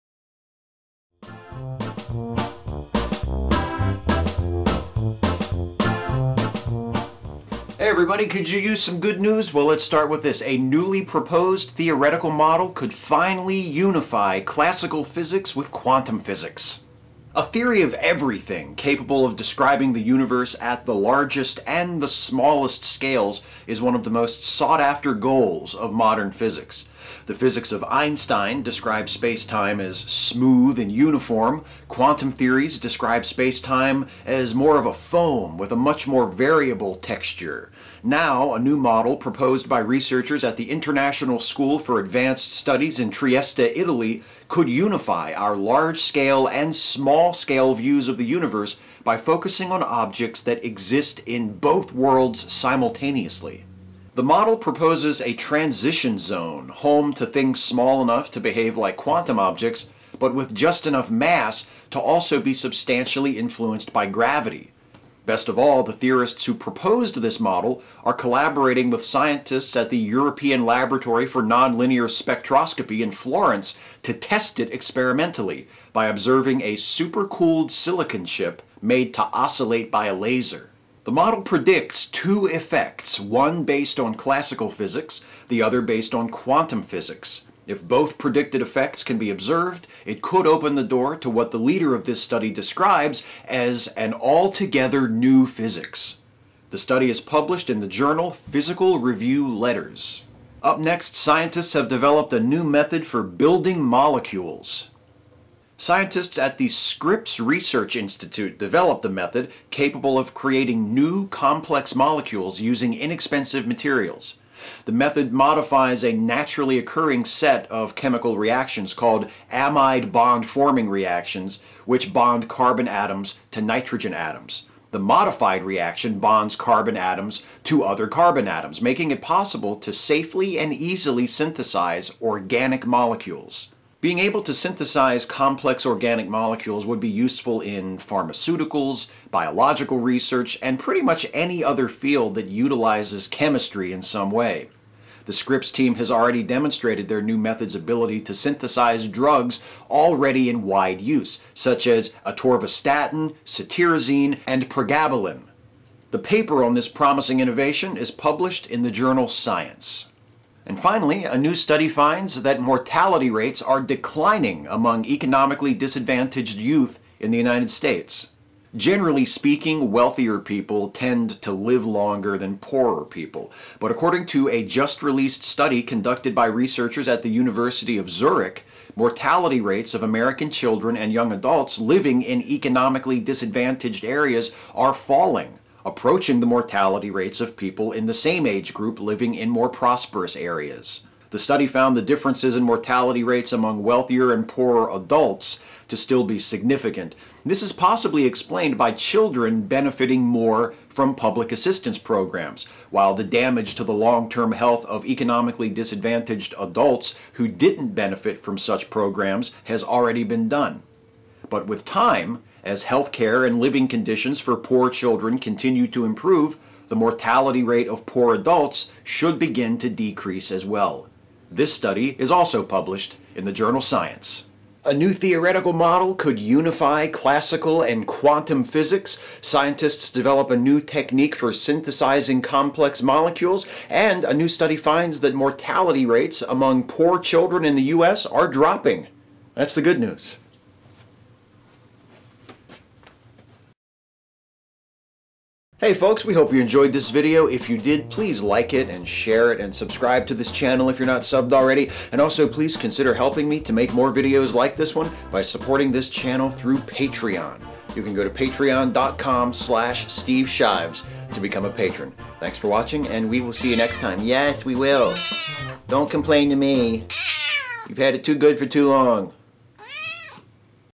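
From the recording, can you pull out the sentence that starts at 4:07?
If you did, please like it and share it and subscribe to this channel if you're not subbed already.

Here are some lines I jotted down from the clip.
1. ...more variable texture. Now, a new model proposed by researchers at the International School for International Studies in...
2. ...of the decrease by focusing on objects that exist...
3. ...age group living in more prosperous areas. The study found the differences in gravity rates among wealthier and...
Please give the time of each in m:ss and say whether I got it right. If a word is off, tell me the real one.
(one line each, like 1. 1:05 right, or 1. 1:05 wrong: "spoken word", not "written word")
1. 0:36 wrong: "Advanced", not "International"
2. 0:48 wrong: "universe", not "decrease"
3. 3:08 wrong: "mortality", not "gravity".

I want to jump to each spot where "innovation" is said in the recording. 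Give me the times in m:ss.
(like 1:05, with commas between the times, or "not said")
2:37.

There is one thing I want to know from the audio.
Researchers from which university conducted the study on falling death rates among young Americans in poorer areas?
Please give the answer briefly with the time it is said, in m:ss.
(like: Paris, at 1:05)
University of Zurich, at 2:57.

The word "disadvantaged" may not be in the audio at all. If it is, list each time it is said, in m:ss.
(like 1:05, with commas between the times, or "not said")
2:45, 3:03, 3:25.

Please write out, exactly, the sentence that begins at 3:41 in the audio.
This study is also published in the journal Science.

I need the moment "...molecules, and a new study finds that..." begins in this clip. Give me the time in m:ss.
3:53.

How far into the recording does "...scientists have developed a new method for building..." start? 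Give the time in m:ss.
1:41.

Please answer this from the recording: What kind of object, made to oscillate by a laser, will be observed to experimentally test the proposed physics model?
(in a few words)
Supercooled silicon chip.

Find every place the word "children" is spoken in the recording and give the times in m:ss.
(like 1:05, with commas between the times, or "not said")
3:00, 3:18, 3:34, 3:57.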